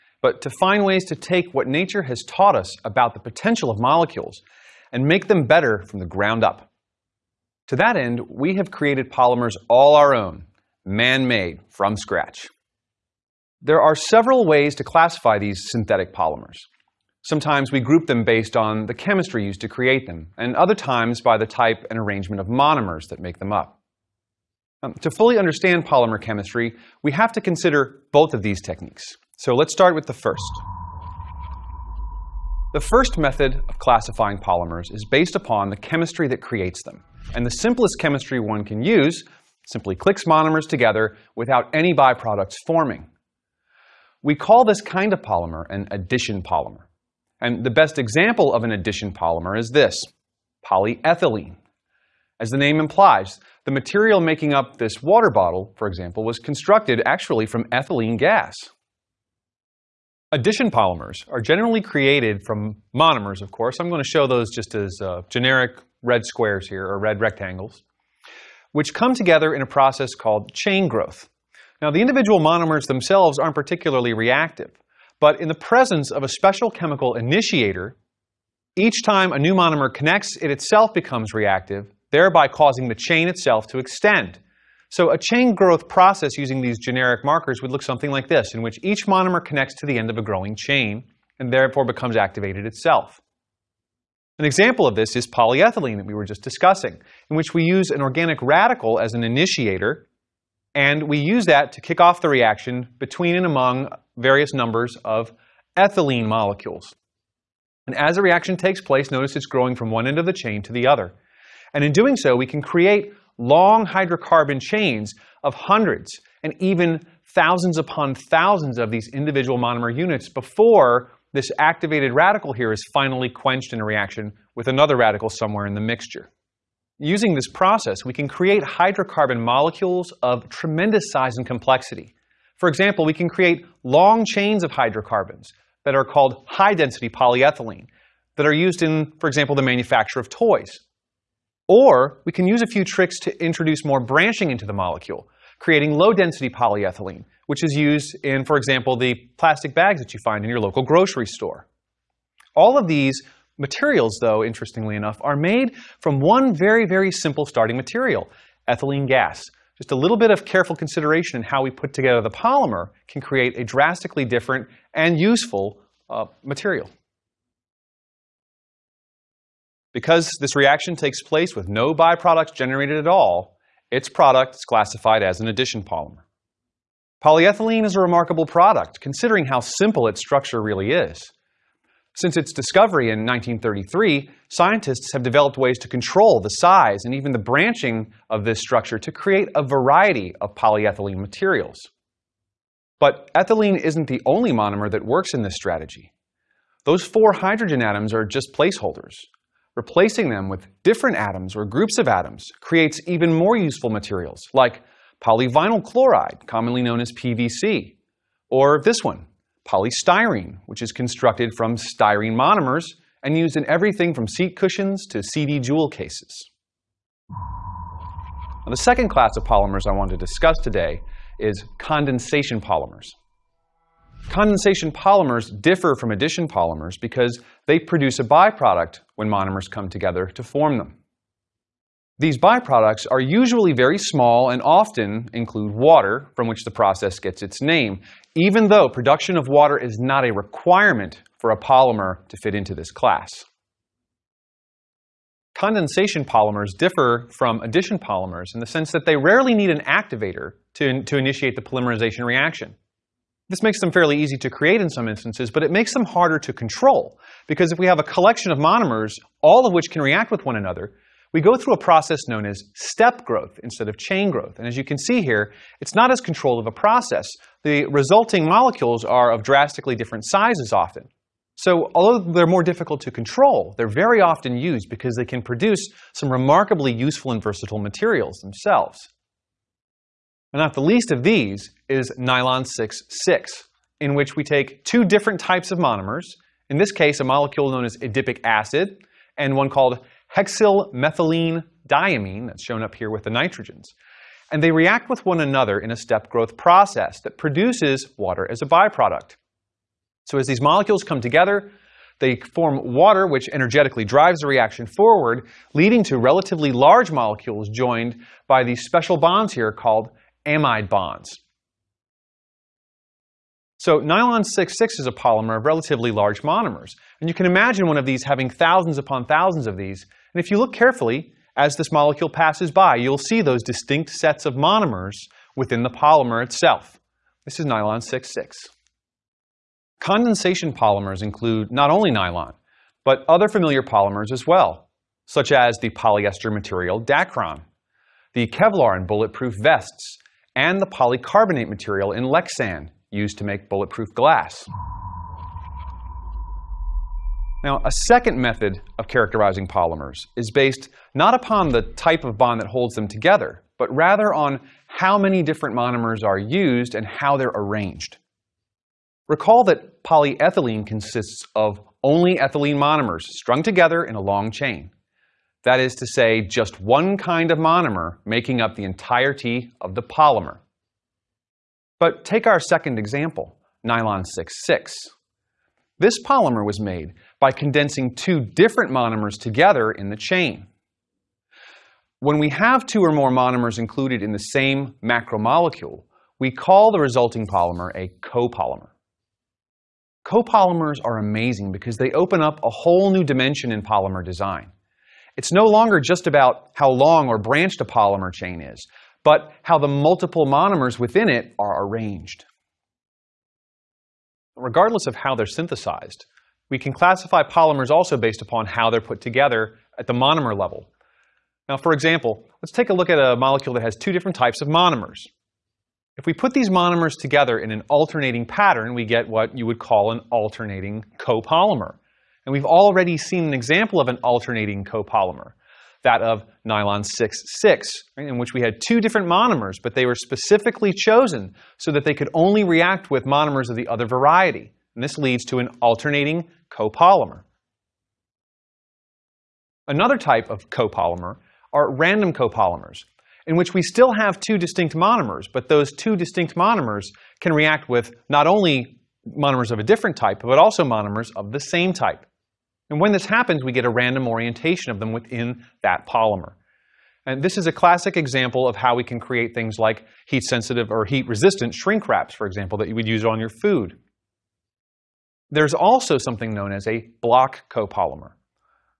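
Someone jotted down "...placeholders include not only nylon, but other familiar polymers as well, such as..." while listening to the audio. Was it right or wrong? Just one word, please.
wrong.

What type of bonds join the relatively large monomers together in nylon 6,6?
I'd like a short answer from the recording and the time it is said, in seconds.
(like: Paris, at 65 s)
amide bonds, at 310 s.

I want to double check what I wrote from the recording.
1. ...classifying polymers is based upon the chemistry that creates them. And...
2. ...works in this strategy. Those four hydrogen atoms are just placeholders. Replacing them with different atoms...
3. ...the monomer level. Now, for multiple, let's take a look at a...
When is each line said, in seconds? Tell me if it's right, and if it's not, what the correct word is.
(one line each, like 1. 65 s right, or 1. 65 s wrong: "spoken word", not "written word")
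1. 33 s right
2. 195 s right
3. 410 s wrong: "example", not "multiple".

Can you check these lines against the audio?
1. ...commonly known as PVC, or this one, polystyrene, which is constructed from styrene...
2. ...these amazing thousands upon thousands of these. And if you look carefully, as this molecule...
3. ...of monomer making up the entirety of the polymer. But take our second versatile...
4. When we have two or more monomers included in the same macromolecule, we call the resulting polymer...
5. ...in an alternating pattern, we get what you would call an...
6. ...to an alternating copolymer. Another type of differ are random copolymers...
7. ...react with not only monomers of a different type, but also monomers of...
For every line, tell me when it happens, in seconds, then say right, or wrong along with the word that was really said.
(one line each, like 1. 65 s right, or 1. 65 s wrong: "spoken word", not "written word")
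1. 206 s right
2. 318 s wrong: "having", not "amazing"
3. 367 s wrong: "example", not "versatile"
4. 382 s right
5. 417 s right
6. 435 s wrong: "copolymer", not "differ"
7. 447 s right.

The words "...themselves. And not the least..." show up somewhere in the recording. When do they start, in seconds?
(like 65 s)
278 s.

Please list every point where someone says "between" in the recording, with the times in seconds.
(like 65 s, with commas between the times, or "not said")
102 s.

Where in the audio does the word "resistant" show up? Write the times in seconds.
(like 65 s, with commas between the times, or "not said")
461 s.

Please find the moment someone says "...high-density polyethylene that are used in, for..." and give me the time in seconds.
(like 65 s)
136 s.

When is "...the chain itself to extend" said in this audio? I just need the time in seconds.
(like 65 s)
82 s.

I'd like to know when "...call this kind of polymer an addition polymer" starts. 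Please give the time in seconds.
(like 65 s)
44 s.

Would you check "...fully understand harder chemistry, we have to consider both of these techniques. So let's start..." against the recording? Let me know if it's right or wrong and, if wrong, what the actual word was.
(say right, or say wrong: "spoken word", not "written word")
wrong: "polymer", not "harder".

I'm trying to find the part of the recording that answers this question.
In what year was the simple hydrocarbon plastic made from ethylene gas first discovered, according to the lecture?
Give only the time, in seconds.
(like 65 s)
183 s.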